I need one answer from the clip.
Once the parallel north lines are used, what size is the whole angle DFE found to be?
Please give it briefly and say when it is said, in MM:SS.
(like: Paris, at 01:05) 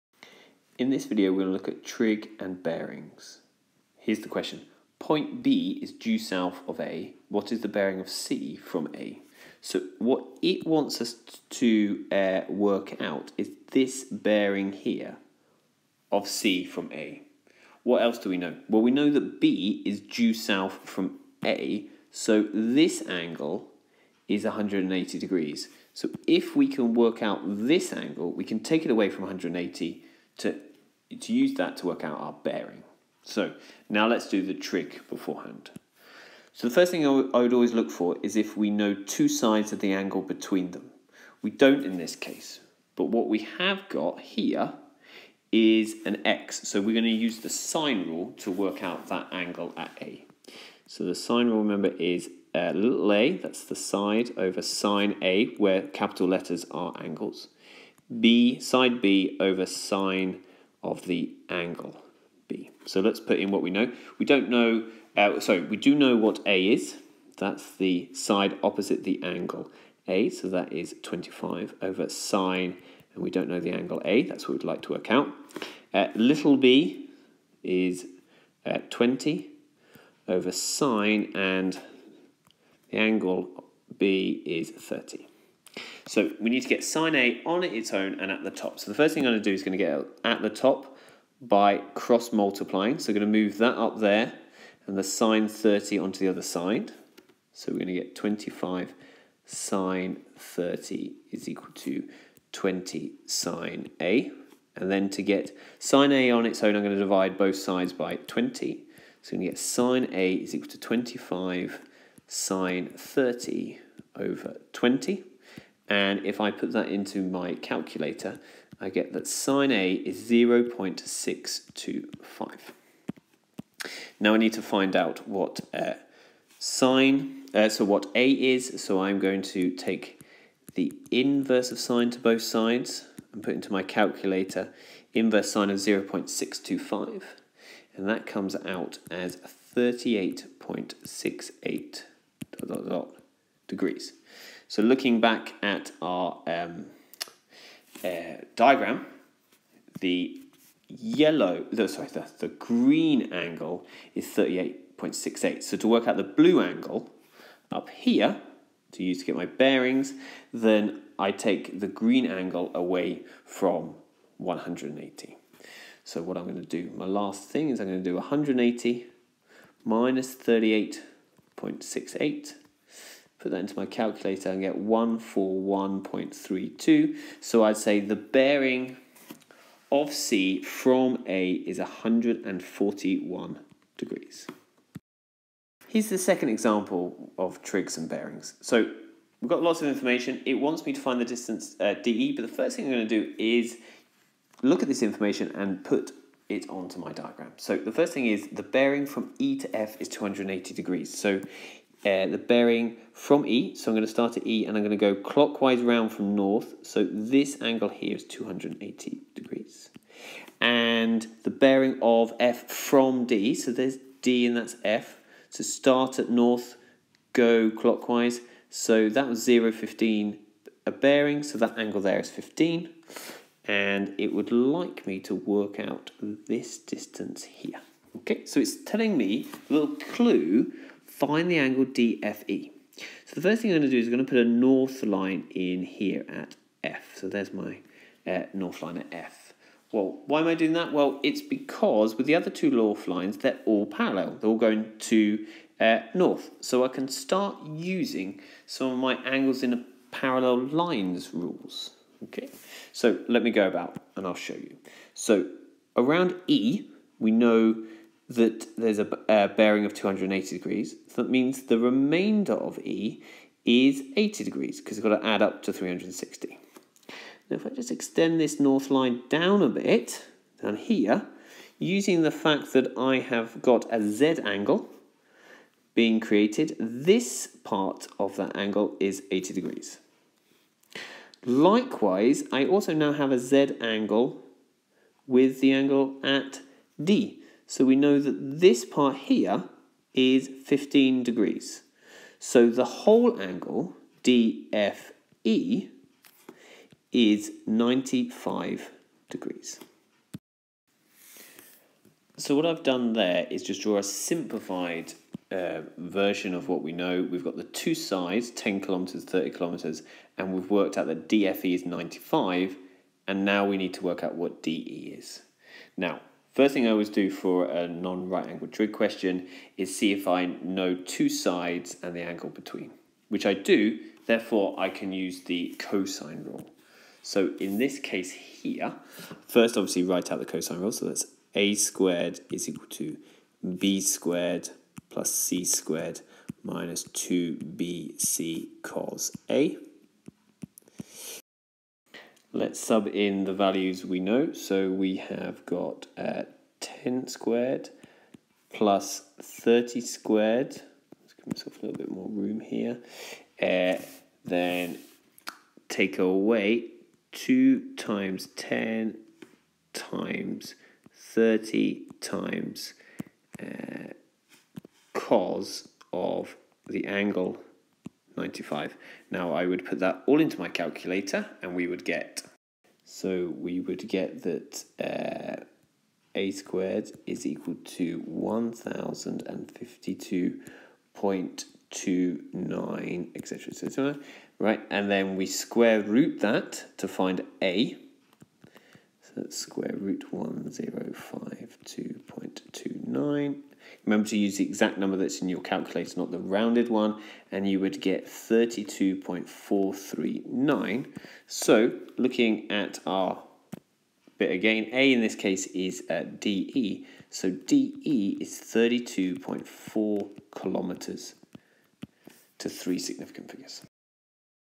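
95 degrees, at 04:57.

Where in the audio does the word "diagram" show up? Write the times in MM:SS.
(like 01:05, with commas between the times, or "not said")
02:28, 03:17.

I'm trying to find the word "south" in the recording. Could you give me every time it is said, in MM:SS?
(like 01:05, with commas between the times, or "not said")
00:06, 00:20.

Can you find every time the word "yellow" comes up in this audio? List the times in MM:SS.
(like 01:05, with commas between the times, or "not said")
02:30.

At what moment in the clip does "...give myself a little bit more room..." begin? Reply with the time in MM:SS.
05:51.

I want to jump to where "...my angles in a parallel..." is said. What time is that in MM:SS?
04:08.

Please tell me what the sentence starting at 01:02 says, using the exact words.
So let's put in what we know.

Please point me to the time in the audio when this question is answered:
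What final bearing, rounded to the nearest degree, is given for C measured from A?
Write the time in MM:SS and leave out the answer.
03:01.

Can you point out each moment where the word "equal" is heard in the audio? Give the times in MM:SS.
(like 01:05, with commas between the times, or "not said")
01:41, 01:50, 05:32, 06:17.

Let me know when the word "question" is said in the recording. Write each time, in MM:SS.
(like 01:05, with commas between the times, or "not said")
00:04, 05:18.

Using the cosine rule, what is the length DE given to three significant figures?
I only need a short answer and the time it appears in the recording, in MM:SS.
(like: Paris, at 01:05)
32.4 kilometres, at 06:48.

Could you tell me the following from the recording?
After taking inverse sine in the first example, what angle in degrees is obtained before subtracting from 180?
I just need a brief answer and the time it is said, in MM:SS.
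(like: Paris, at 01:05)
38.68, at 02:19.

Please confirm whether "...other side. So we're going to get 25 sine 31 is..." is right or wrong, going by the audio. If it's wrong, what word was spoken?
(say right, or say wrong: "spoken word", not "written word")
wrong: "30", not "31".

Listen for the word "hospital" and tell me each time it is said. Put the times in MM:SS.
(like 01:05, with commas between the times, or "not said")
not said.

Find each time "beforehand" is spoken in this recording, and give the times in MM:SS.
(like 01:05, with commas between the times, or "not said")
00:35.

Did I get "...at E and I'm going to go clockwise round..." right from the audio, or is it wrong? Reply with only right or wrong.
right.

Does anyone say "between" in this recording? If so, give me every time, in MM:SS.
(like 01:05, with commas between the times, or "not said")
00:40, 05:22.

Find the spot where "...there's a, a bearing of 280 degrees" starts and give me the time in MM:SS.
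04:18.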